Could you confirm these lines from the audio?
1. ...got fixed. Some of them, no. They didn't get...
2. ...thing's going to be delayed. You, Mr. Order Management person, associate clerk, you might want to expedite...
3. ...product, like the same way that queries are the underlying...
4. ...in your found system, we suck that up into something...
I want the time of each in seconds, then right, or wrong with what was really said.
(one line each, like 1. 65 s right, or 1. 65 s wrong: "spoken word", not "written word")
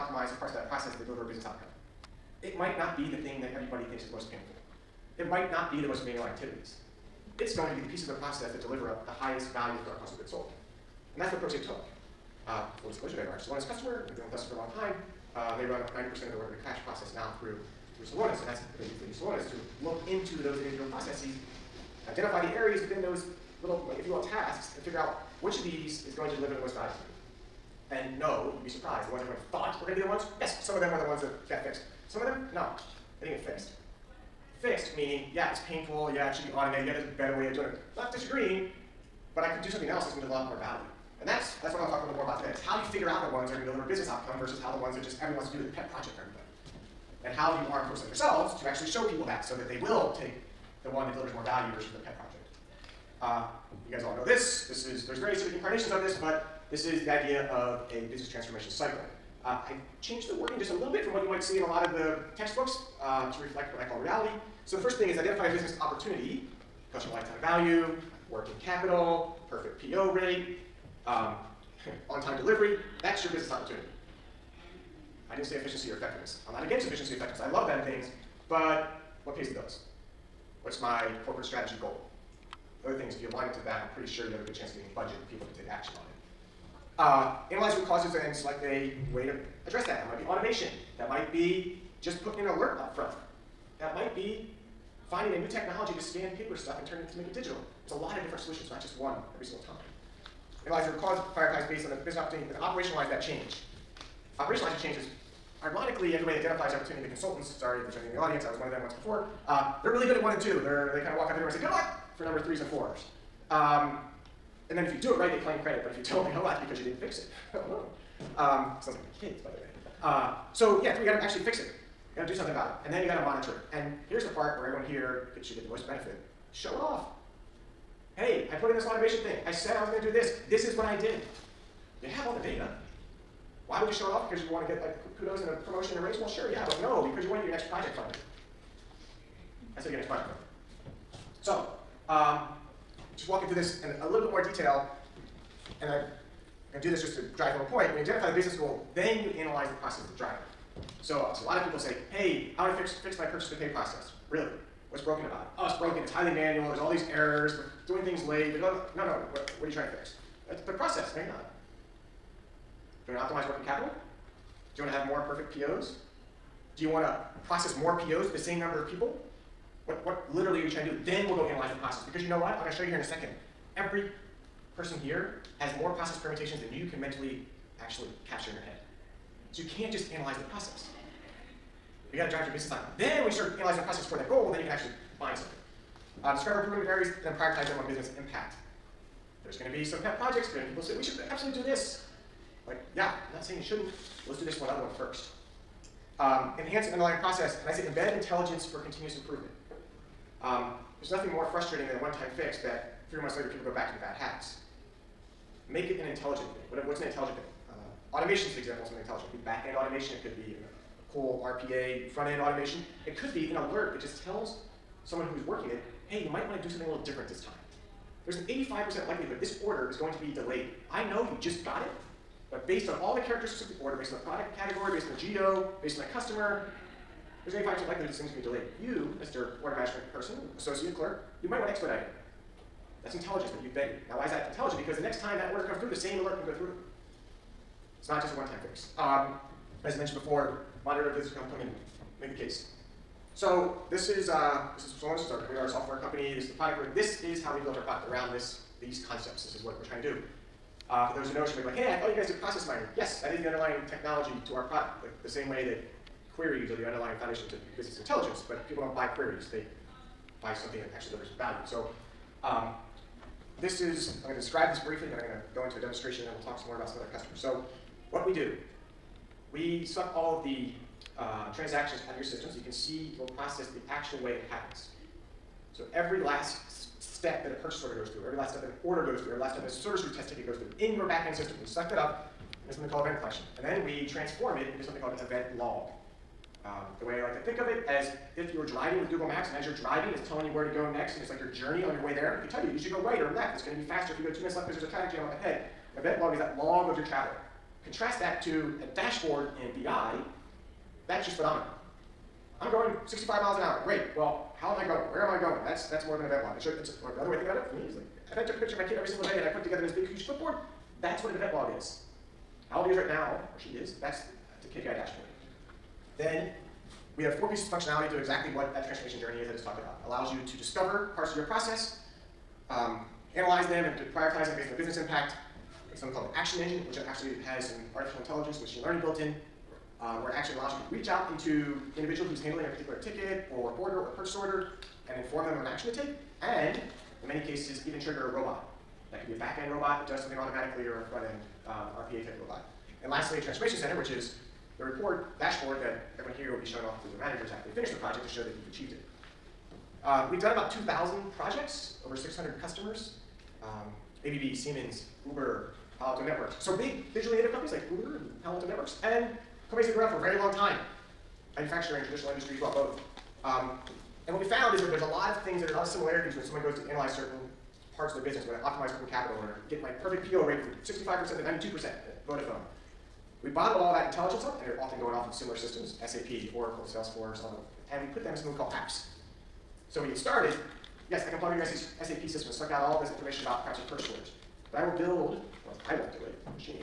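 1. 31 s right
2. 228 s right
3. 254 s right
4. 280 s wrong: "backend", not "found".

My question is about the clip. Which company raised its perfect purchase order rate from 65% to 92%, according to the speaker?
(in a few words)
Vodafone.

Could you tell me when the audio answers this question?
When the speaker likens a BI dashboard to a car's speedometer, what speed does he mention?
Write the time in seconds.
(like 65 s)
303 s.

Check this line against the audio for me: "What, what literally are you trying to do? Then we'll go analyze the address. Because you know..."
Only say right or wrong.
wrong.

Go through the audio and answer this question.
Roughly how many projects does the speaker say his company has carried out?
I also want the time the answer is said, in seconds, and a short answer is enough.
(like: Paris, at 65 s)
2,000, at 350 s.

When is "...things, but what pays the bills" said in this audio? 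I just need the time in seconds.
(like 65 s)
77 s.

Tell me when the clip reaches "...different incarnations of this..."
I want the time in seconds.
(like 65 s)
55 s.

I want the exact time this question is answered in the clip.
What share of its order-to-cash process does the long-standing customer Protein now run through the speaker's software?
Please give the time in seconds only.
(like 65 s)
15 s.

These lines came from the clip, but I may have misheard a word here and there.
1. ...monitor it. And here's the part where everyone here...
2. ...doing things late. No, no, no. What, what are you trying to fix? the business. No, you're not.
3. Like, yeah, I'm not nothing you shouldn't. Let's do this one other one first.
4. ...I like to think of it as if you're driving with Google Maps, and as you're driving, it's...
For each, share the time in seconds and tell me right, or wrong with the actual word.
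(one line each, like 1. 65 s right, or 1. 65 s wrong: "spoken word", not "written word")
1. 123 s right
2. 158 s wrong: "process", not "business"
3. 192 s wrong: "saying", not "nothing"
4. 287 s right.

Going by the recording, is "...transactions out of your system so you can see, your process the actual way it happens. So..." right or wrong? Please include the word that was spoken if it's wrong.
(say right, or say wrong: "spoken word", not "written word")
right.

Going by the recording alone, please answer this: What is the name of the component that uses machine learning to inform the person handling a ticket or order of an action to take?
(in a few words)
action engine.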